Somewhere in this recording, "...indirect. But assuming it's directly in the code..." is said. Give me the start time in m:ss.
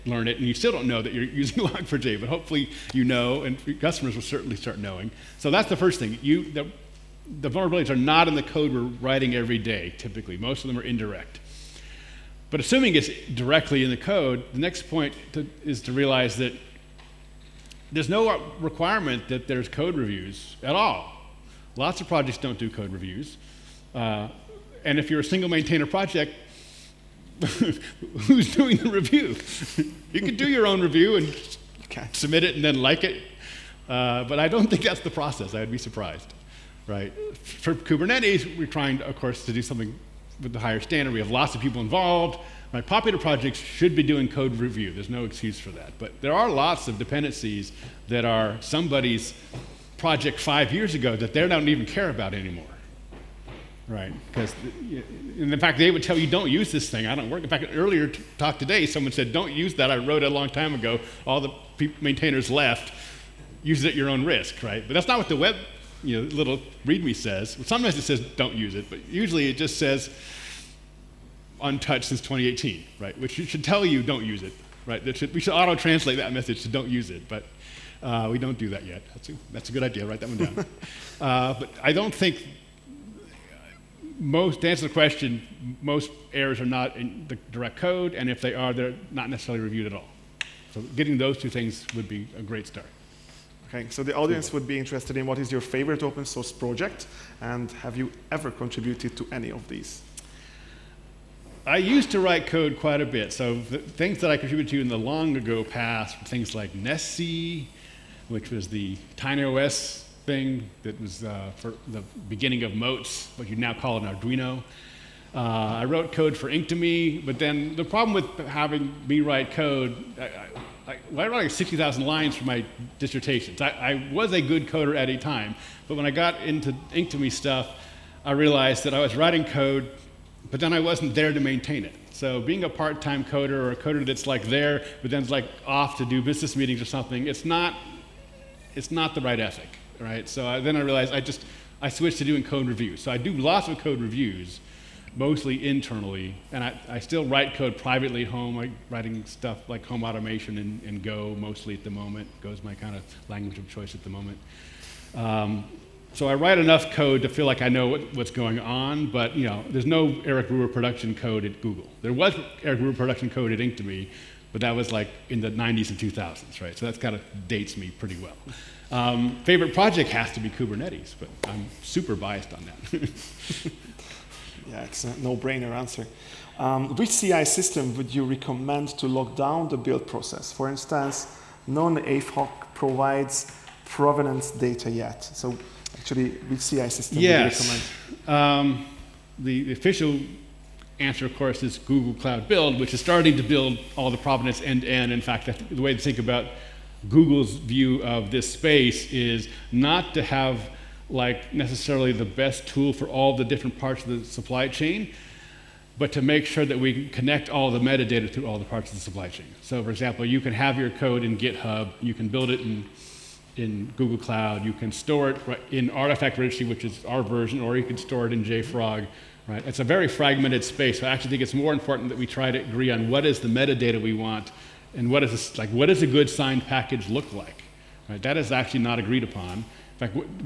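0:10.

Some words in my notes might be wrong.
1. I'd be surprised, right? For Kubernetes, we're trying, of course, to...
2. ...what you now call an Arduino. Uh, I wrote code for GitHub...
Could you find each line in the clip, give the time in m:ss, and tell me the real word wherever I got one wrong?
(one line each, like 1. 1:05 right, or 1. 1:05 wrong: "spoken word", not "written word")
1. 0:35 right
2. 1:53 wrong: "Inktomi", not "GitHub".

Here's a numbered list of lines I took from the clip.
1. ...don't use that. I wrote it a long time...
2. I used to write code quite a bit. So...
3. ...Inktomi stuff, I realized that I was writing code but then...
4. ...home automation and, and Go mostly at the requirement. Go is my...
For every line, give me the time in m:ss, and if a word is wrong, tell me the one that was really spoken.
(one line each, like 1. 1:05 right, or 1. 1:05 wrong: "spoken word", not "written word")
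1. 0:59 right
2. 1:41 right
3. 2:06 right
4. 2:29 wrong: "moment", not "requirement".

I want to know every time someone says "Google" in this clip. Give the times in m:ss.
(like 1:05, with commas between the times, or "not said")
2:41, 3:11, 3:17, 3:33.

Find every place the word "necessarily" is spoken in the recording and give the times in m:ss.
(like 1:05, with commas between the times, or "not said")
1:29, 3:21.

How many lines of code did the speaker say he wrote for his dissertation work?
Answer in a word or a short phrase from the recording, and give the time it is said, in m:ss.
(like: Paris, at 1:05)
60,000, at 2:01.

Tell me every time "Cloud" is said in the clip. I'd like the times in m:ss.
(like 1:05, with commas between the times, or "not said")
3:12, 3:34.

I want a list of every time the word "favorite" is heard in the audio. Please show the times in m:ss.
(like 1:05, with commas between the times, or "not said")
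1:35, 2:49.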